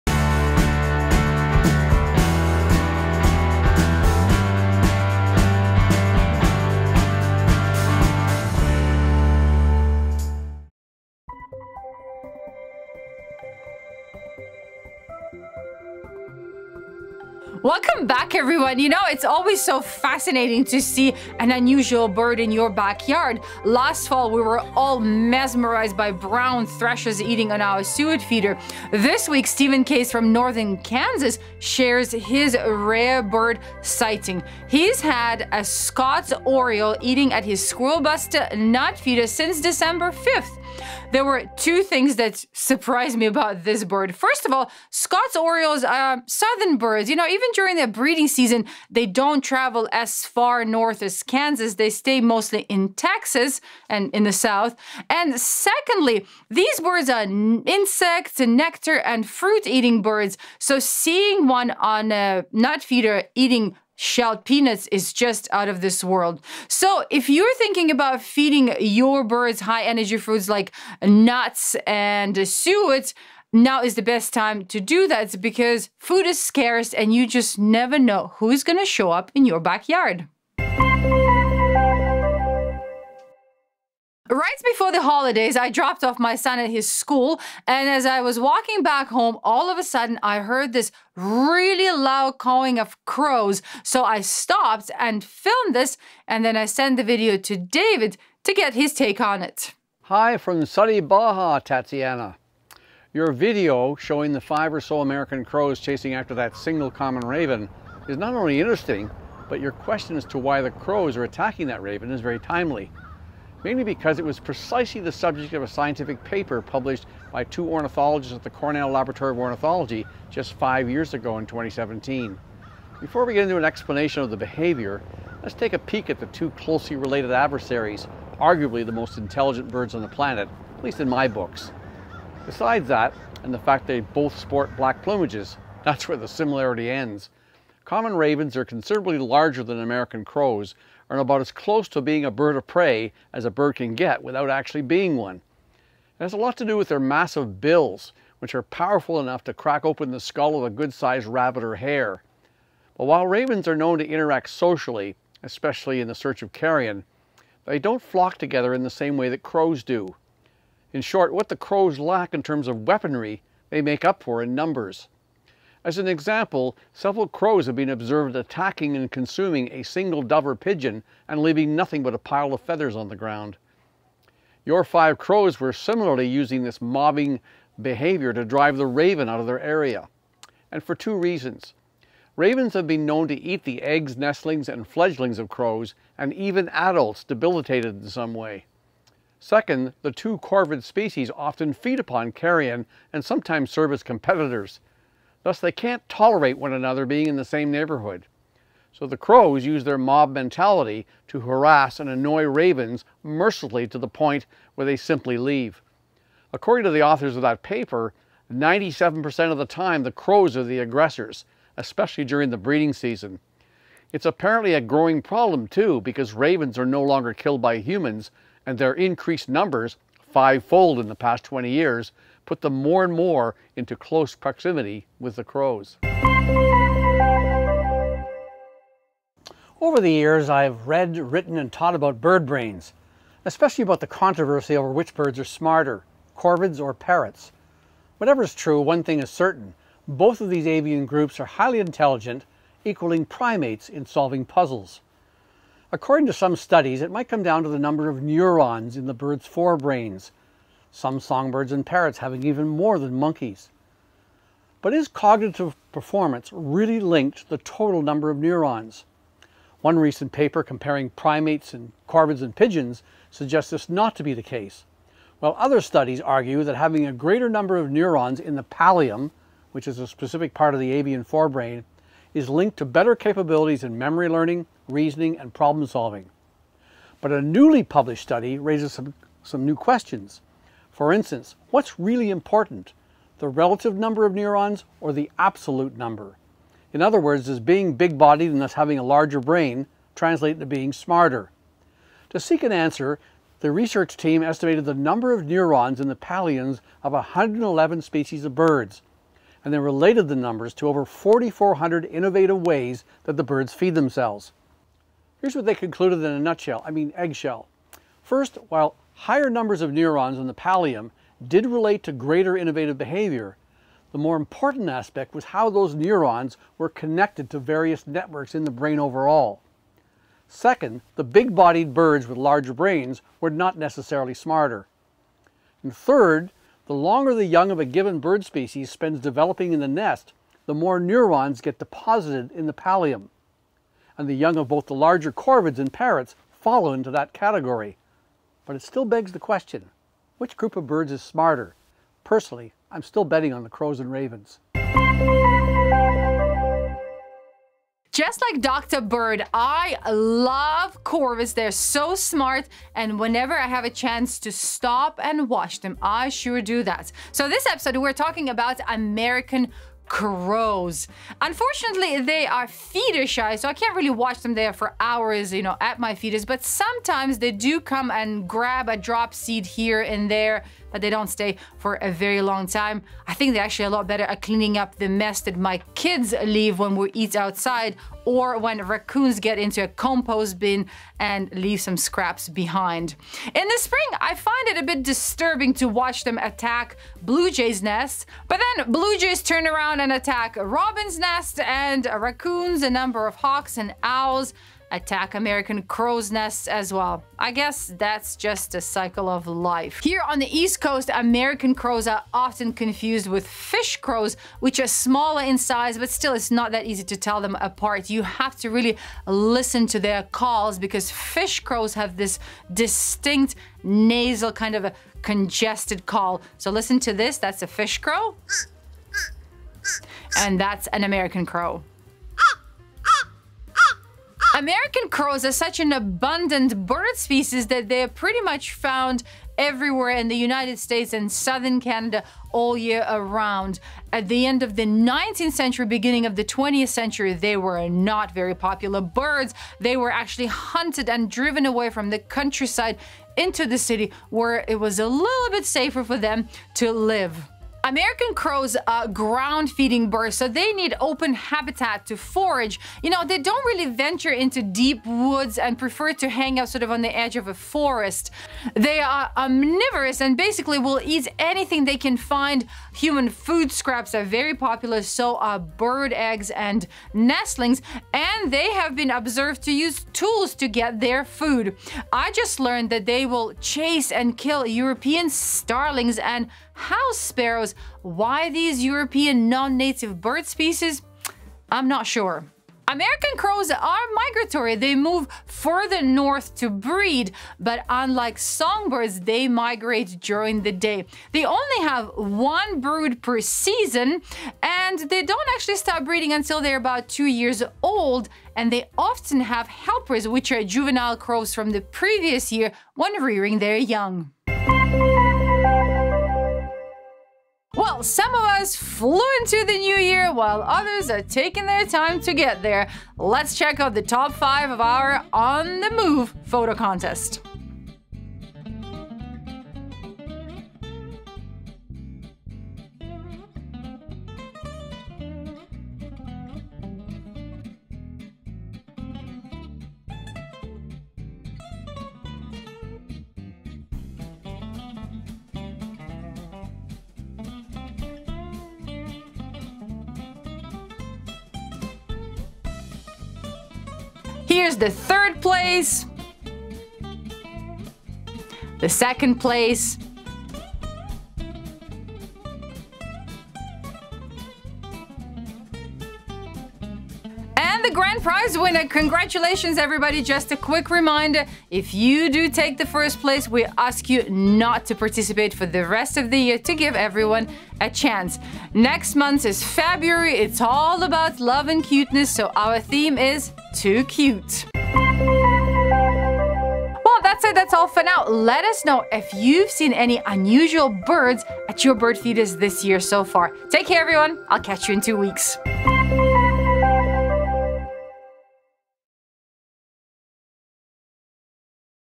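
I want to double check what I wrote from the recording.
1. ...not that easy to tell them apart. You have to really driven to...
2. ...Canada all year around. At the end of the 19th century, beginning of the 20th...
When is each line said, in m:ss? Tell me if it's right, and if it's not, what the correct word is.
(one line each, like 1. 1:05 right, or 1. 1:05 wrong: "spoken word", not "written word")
1. 6:46 wrong: "listen", not "driven"
2. 7:11 right.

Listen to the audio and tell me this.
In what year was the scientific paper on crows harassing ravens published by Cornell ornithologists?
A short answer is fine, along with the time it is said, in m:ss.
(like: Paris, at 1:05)
2017, at 2:01.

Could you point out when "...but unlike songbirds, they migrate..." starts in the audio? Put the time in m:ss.
8:07.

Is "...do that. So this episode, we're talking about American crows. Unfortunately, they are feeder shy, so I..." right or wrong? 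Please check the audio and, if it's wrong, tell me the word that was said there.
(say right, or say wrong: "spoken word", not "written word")
right.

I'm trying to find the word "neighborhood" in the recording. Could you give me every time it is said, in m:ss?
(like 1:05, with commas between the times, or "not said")
3:17.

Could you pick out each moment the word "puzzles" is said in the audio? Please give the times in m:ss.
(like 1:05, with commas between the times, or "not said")
4:04.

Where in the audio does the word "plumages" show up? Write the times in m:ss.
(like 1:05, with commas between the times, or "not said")
2:15.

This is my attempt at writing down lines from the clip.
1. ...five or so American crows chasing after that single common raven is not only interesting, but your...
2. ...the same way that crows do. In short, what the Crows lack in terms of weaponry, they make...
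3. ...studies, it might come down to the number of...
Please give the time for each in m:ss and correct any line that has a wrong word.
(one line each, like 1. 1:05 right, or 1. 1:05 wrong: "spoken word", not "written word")
1. 1:44 right
2. 2:38 right
3. 4:06 right.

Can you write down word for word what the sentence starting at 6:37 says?
I guess that's just a cycle of life.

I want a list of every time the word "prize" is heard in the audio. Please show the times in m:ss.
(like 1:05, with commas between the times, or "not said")
9:18.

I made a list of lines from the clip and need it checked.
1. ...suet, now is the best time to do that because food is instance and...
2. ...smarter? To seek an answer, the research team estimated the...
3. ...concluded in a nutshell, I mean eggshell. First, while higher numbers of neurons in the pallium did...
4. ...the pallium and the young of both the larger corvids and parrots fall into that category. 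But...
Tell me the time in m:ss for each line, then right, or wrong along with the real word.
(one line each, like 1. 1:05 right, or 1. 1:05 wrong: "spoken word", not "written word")
1. 1:12 wrong: "scarce", not "instance"
2. 4:50 right
3. 5:05 right
4. 5:32 right.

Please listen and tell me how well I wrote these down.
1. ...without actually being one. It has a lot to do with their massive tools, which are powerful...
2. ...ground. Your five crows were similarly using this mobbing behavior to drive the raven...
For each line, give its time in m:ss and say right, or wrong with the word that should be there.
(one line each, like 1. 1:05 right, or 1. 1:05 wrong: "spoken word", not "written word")
1. 2:24 wrong: "bills", not "tools"
2. 2:53 right.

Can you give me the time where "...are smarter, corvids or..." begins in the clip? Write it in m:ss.
3:55.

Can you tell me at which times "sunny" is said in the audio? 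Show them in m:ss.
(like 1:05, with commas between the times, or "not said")
1:40.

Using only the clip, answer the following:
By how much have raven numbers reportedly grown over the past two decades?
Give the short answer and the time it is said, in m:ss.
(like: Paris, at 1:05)
fivefold, at 3:40.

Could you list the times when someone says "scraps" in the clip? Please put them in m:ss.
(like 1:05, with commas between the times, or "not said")
6:21, 7:43.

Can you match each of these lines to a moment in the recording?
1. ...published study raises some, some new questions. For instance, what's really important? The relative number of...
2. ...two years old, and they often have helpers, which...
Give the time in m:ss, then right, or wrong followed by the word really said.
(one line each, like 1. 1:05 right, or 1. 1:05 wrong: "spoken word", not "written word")
1. 4:37 right
2. 8:17 right.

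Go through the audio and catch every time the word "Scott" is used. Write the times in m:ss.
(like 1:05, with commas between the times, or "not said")
0:35, 0:44.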